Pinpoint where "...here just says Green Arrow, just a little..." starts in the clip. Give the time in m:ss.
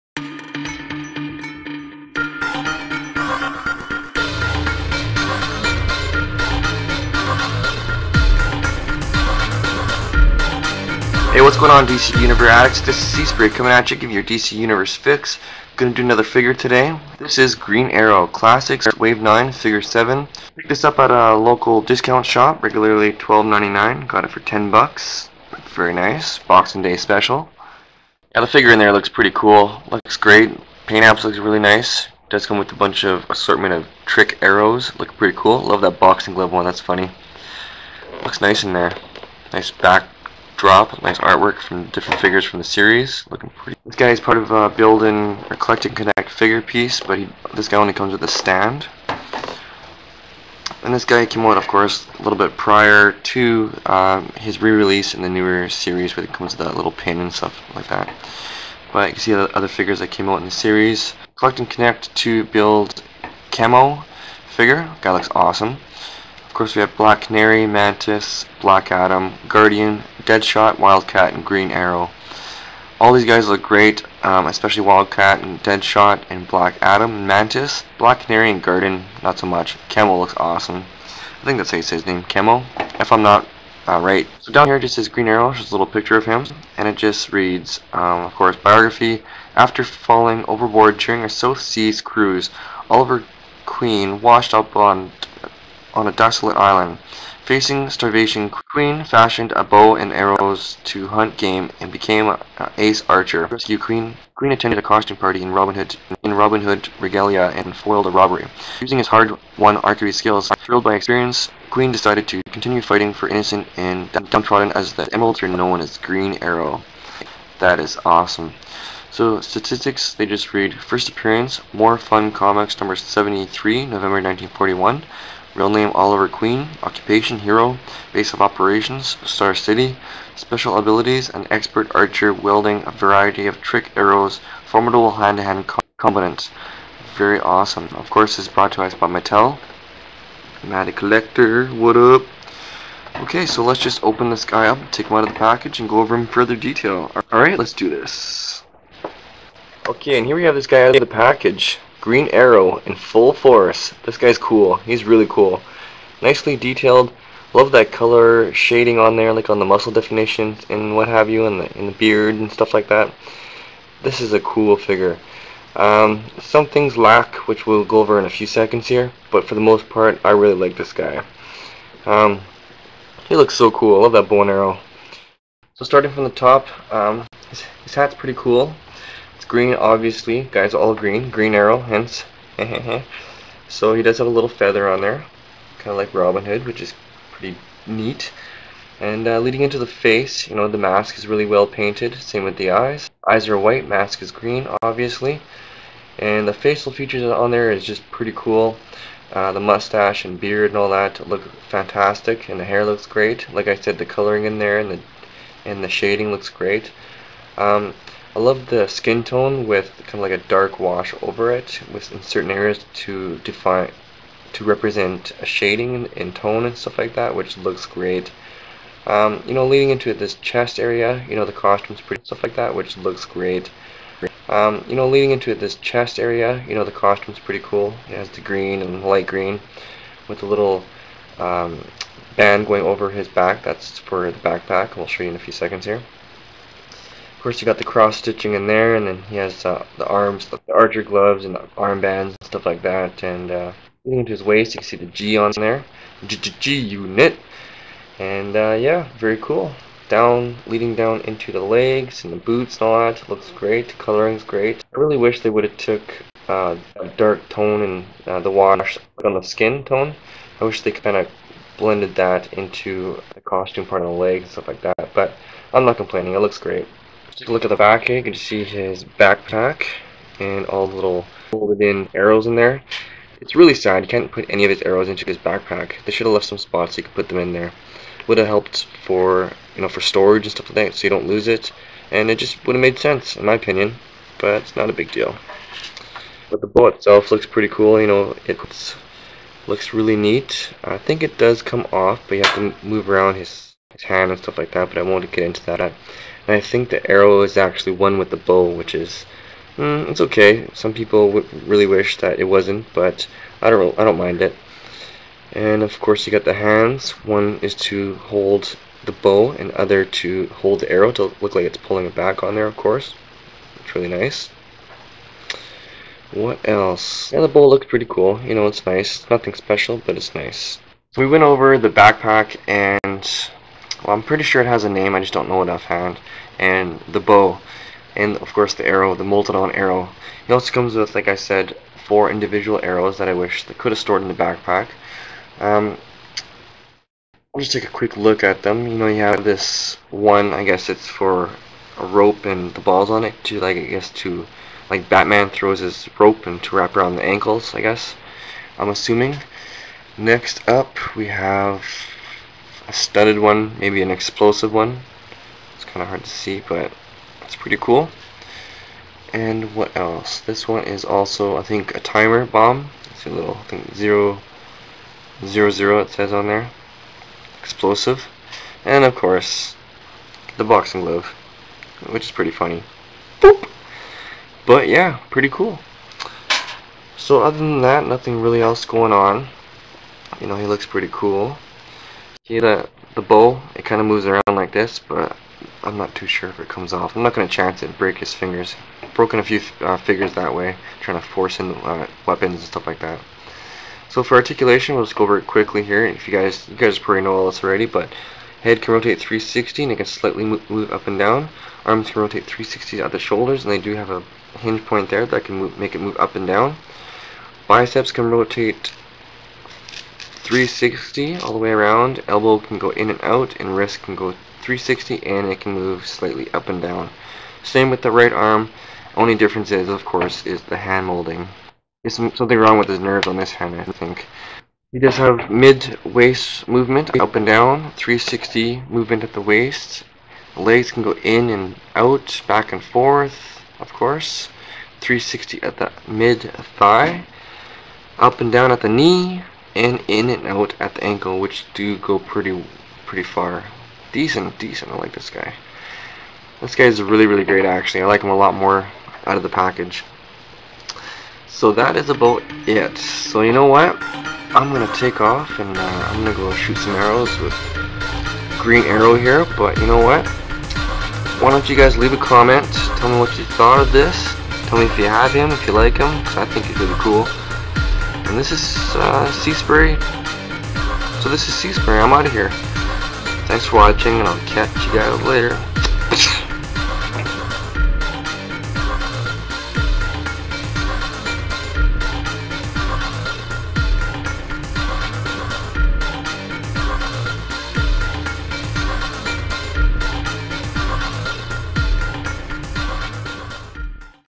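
1:24.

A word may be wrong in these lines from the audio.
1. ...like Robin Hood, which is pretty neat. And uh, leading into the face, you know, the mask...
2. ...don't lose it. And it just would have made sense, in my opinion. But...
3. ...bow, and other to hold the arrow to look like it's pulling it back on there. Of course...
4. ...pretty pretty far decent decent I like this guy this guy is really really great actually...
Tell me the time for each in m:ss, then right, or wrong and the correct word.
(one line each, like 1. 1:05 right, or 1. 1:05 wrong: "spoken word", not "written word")
1. 3:05 right
2. 4:41 right
3. 5:09 right
4. 7:22 right.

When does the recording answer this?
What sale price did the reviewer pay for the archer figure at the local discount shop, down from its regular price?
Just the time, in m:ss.
0:24.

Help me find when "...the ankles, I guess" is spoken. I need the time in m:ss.
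5:47.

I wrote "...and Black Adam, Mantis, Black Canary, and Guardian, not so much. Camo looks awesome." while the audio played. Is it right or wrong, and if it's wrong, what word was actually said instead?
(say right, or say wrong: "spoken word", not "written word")
right.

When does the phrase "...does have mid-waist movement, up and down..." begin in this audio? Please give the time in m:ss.
7:04.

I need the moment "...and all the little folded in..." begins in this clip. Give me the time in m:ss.
4:30.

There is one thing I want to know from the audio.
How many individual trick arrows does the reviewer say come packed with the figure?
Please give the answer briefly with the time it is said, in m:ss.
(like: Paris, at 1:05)
4, at 5:32.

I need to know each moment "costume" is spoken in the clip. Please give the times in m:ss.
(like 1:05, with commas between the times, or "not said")
1:44, 3:41, 3:47, 4:23.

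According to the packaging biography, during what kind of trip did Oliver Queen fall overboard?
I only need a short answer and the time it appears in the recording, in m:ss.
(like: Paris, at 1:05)
South Seas cruise, at 1:31.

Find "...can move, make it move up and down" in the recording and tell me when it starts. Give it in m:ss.
6:45.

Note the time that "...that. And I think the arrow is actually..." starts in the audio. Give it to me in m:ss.
4:55.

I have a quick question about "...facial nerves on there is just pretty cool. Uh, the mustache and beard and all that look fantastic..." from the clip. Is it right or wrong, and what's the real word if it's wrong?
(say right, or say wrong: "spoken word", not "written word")
wrong: "features", not "nerves".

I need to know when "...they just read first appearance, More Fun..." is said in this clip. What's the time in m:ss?
2:00.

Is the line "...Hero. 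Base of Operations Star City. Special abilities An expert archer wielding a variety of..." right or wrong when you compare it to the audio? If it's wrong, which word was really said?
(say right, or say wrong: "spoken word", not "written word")
right.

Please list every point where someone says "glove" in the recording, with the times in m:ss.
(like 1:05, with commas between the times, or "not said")
0:36, 4:01, 6:11.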